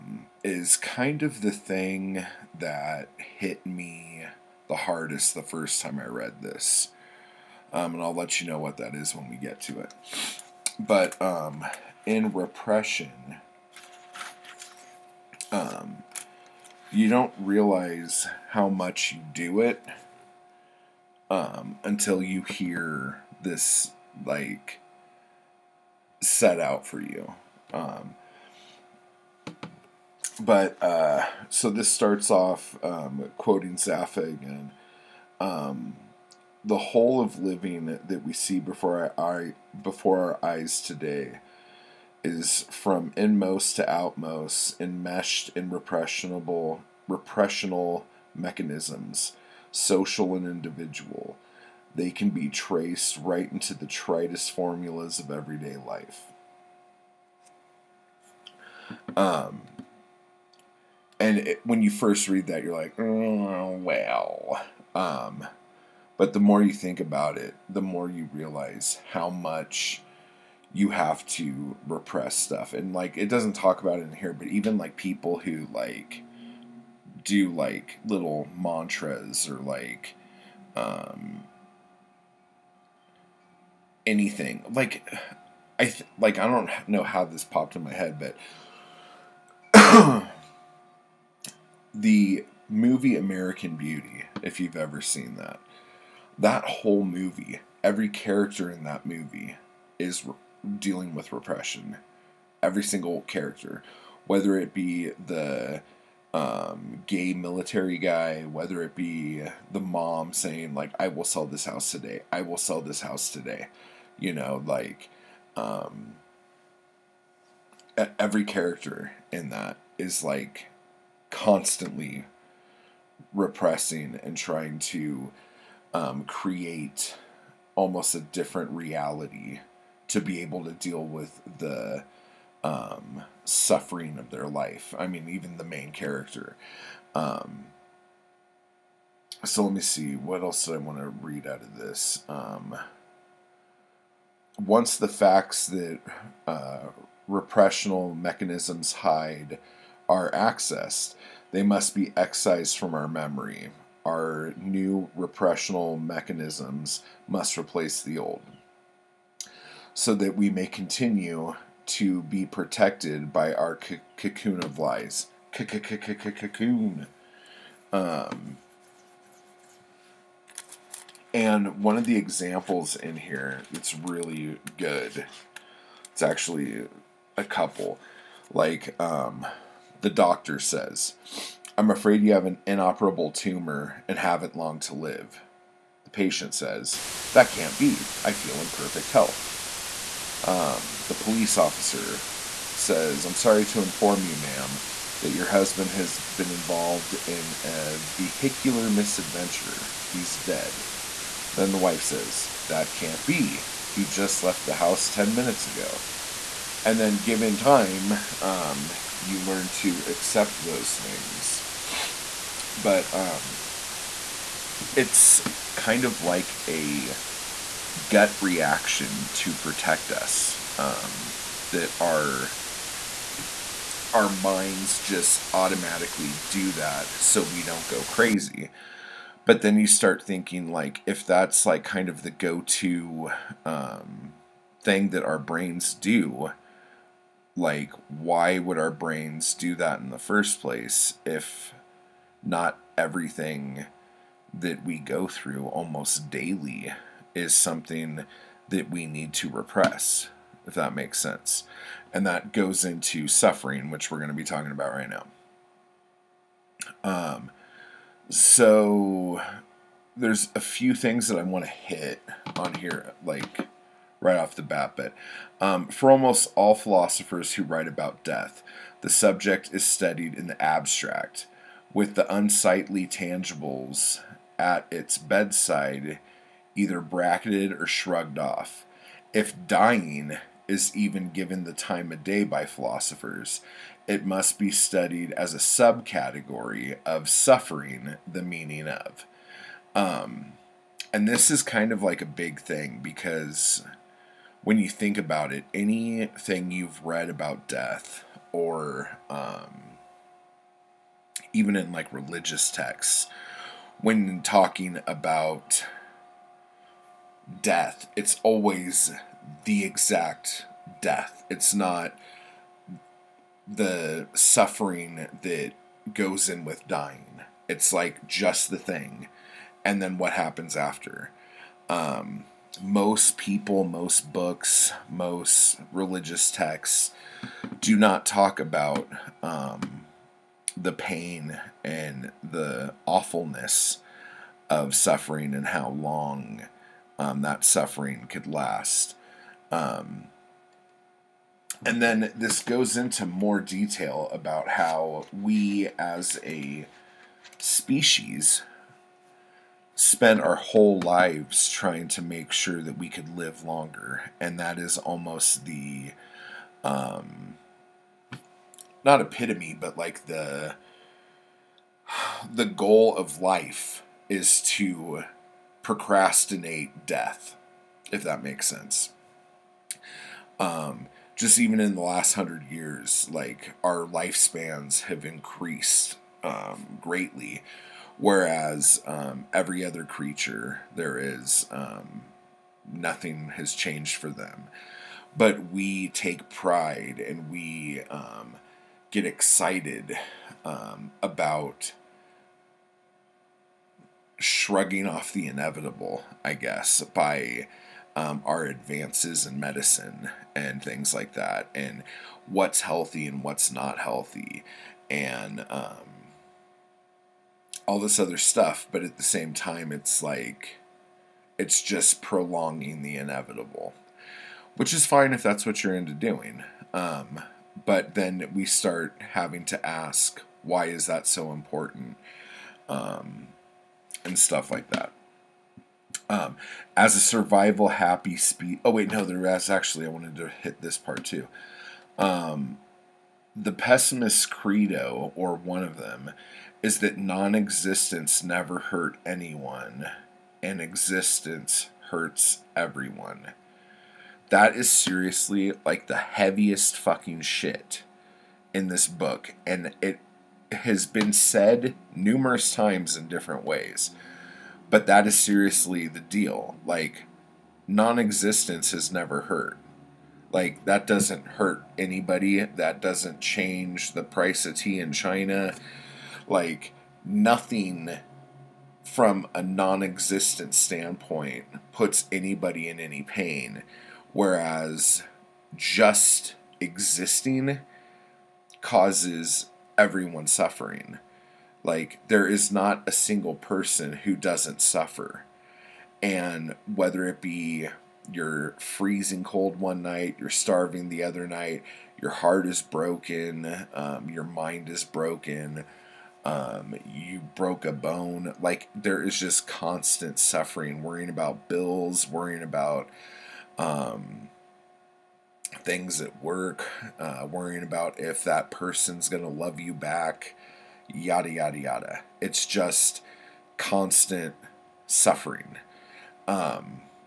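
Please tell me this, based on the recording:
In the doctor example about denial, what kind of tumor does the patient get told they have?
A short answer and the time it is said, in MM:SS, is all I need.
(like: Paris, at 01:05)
inoperable, at 03:02.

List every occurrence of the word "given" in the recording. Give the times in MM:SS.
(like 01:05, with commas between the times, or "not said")
03:27, 04:41.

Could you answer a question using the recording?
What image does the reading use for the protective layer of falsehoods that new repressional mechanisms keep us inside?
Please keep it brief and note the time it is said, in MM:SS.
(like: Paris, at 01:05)
cocoon of lies, at 02:44.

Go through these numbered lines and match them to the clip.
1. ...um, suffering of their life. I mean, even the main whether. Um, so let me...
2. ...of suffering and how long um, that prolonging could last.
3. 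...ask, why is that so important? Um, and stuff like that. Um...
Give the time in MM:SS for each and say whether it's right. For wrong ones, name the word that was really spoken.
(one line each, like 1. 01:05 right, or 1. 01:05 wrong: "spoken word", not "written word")
1. 02:12 wrong: "character", not "whether"
2. 05:34 wrong: "suffering", not "prolonging"
3. 06:59 right.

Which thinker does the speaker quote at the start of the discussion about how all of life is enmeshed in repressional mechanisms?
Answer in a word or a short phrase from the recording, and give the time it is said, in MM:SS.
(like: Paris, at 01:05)
Zapffe, at 00:33.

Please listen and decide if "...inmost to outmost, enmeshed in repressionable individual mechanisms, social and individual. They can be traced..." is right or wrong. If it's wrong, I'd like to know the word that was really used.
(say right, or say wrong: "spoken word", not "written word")
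wrong: "repressional", not "individual".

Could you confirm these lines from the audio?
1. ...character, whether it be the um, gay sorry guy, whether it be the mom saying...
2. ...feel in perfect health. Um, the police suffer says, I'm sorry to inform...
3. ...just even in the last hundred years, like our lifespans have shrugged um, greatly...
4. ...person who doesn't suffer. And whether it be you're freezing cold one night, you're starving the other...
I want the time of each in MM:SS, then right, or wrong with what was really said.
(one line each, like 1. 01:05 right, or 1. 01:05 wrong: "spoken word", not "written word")
1. 01:43 wrong: "military", not "sorry"
2. 03:08 wrong: "officer", not "suffer"
3. 06:11 wrong: "increased", not "shrugged"
4. 08:03 right.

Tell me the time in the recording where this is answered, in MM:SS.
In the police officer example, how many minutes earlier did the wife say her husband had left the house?
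03:25.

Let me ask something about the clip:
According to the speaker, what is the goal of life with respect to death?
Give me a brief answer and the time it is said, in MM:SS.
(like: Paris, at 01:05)
procrastinate, at 06:05.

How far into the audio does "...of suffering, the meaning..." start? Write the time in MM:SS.
04:47.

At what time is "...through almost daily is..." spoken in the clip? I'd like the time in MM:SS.
04:05.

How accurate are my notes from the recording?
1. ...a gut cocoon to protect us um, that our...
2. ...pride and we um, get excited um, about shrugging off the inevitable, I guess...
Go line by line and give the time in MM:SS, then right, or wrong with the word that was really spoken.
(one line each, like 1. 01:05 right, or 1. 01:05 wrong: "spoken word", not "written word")
1. 03:36 wrong: "reaction", not "cocoon"
2. 06:26 right.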